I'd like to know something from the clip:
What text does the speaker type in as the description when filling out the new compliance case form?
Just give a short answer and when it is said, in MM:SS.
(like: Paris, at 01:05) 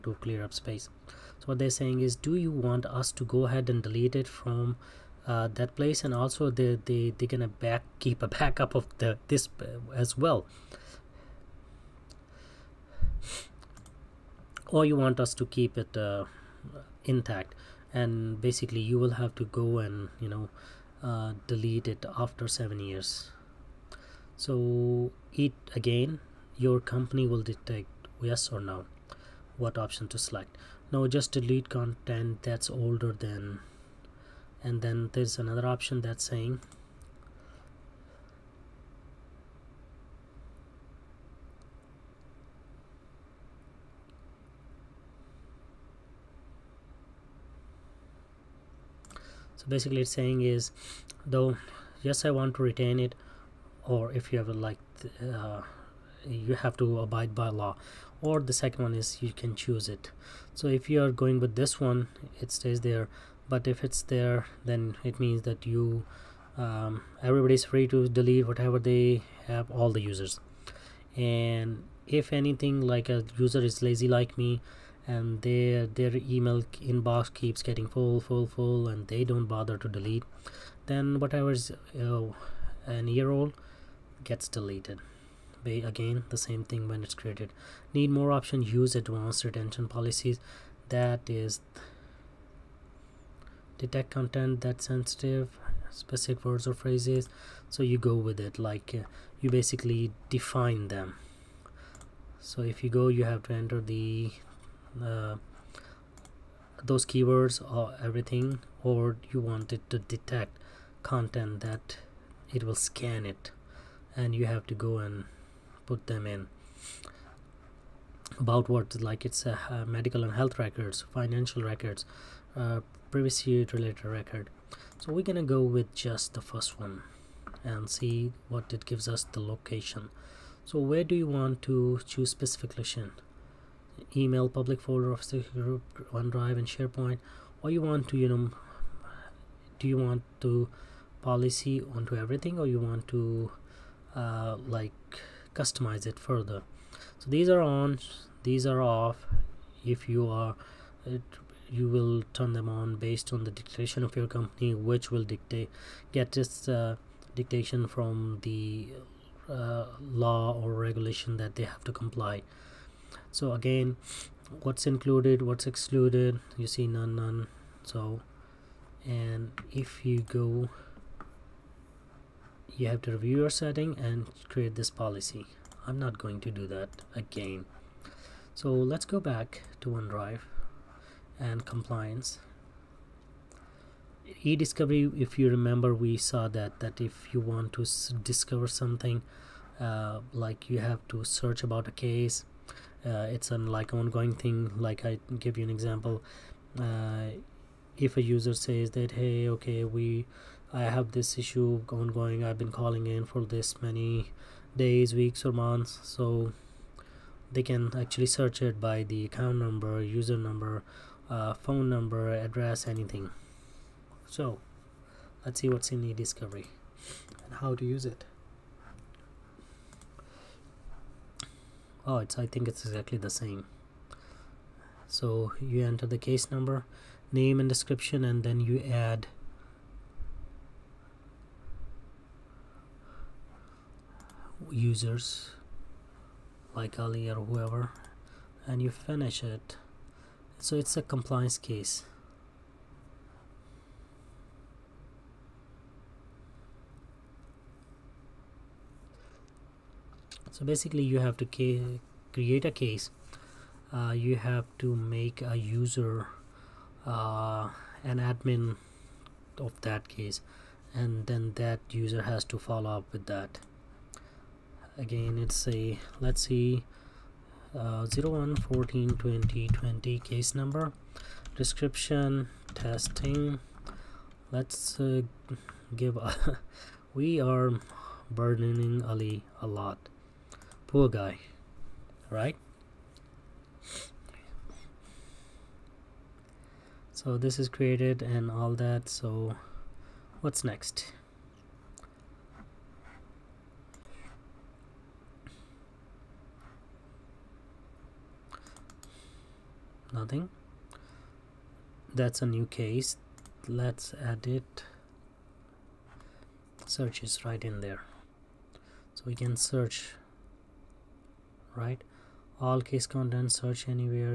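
testing, at 04:32.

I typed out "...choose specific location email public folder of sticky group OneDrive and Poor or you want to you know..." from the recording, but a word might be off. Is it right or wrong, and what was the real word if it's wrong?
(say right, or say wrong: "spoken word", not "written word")
wrong: "SharePoint", not "Poor".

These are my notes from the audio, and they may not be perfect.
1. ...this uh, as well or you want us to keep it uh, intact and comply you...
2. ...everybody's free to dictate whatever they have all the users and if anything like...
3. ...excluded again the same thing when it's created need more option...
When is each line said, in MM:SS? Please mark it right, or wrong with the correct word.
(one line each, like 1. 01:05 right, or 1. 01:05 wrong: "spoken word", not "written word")
1. 00:09 wrong: "basically", not "comply"
2. 01:07 wrong: "delete", not "dictate"
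3. 01:24 wrong: "deleted", not "excluded".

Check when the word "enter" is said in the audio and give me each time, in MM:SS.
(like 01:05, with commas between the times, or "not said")
01:43, 03:45.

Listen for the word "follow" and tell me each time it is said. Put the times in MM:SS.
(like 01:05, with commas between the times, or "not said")
04:22.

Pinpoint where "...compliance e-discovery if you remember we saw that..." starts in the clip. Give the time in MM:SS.
03:01.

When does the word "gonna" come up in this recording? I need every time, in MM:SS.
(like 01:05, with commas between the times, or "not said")
00:07, 02:05.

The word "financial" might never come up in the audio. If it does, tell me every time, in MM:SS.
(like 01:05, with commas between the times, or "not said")
02:01.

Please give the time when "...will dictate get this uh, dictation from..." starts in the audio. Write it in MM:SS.
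02:35.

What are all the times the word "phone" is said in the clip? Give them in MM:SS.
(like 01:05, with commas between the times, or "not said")
03:31.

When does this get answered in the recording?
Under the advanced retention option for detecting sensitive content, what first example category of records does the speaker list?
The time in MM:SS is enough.
01:59.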